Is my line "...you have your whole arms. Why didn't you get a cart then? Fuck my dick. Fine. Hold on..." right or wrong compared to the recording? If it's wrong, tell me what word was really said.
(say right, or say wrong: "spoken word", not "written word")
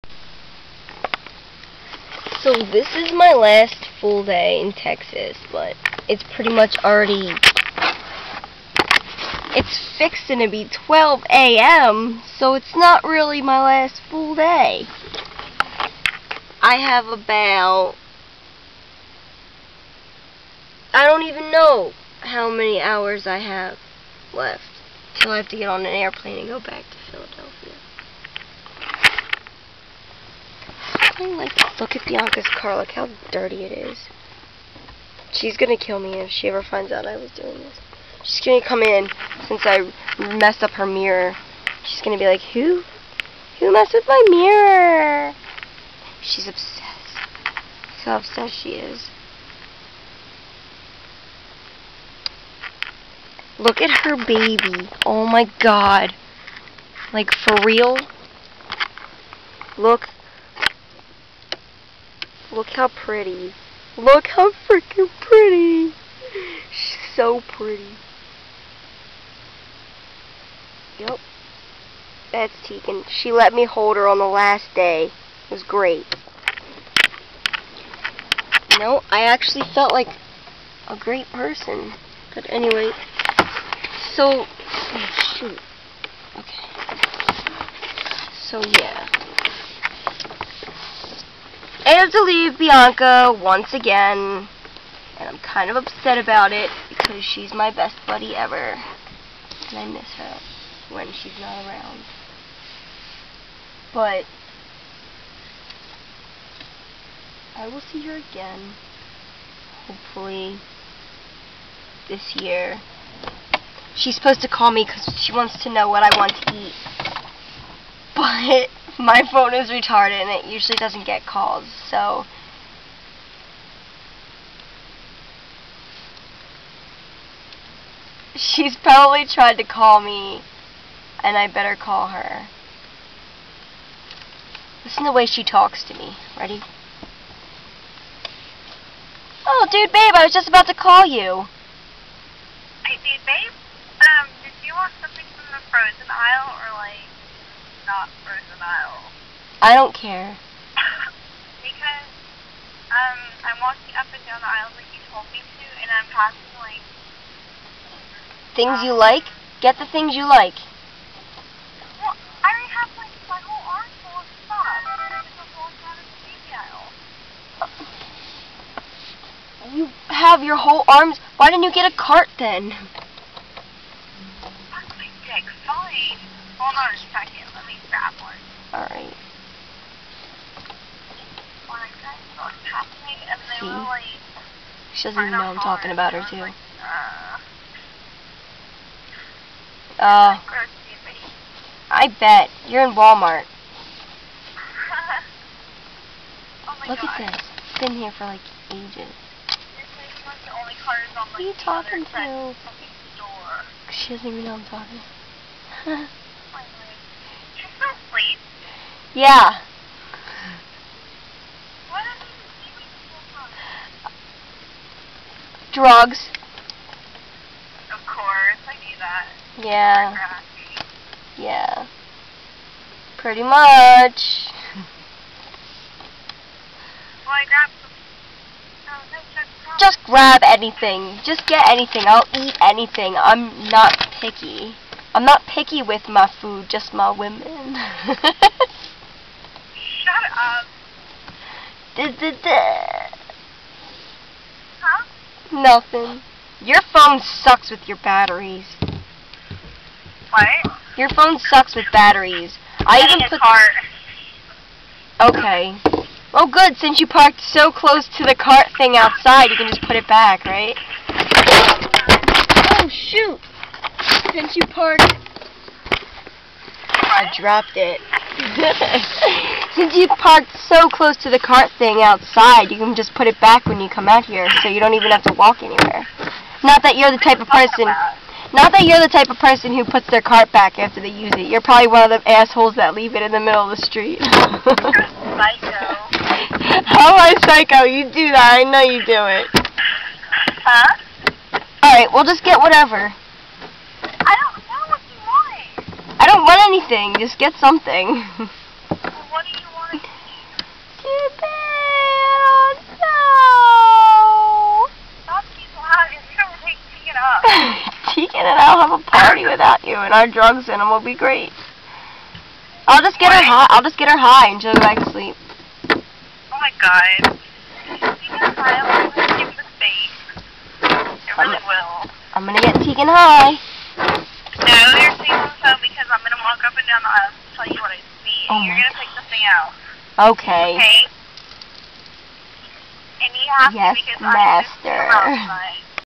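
right.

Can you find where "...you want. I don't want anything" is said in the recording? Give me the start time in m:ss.
4:55.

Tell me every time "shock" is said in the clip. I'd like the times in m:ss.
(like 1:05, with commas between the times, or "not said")
not said.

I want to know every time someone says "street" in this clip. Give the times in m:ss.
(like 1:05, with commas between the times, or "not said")
4:43.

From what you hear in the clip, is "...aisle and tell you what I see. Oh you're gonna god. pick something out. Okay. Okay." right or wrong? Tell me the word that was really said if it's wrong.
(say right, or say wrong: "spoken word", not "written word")
right.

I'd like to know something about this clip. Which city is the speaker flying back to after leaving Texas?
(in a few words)
Philadelphia.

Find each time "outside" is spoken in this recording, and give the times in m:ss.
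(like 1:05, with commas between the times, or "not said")
4:18, 4:32.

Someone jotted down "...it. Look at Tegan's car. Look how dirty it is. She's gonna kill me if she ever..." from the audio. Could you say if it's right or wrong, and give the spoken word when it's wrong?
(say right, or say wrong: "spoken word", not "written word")
wrong: "Bianca", not "Tegan".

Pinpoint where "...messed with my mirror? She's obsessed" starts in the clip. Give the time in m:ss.
0:43.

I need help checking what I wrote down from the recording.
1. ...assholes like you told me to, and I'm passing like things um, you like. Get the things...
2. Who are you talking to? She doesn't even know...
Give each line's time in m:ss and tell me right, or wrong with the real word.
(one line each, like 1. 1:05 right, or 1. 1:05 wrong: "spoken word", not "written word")
1. 2:34 wrong: "aisles", not "assholes"
2. 3:20 right.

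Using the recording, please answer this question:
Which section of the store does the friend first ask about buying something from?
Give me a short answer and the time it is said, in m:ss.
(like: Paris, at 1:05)
frozen aisle, at 2:25.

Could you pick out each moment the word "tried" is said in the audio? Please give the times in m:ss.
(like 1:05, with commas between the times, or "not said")
2:09.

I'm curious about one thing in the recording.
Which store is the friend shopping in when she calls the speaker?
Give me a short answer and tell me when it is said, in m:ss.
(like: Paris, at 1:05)
Walmart, at 3:12.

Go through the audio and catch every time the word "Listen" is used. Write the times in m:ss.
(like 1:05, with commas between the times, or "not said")
2:14.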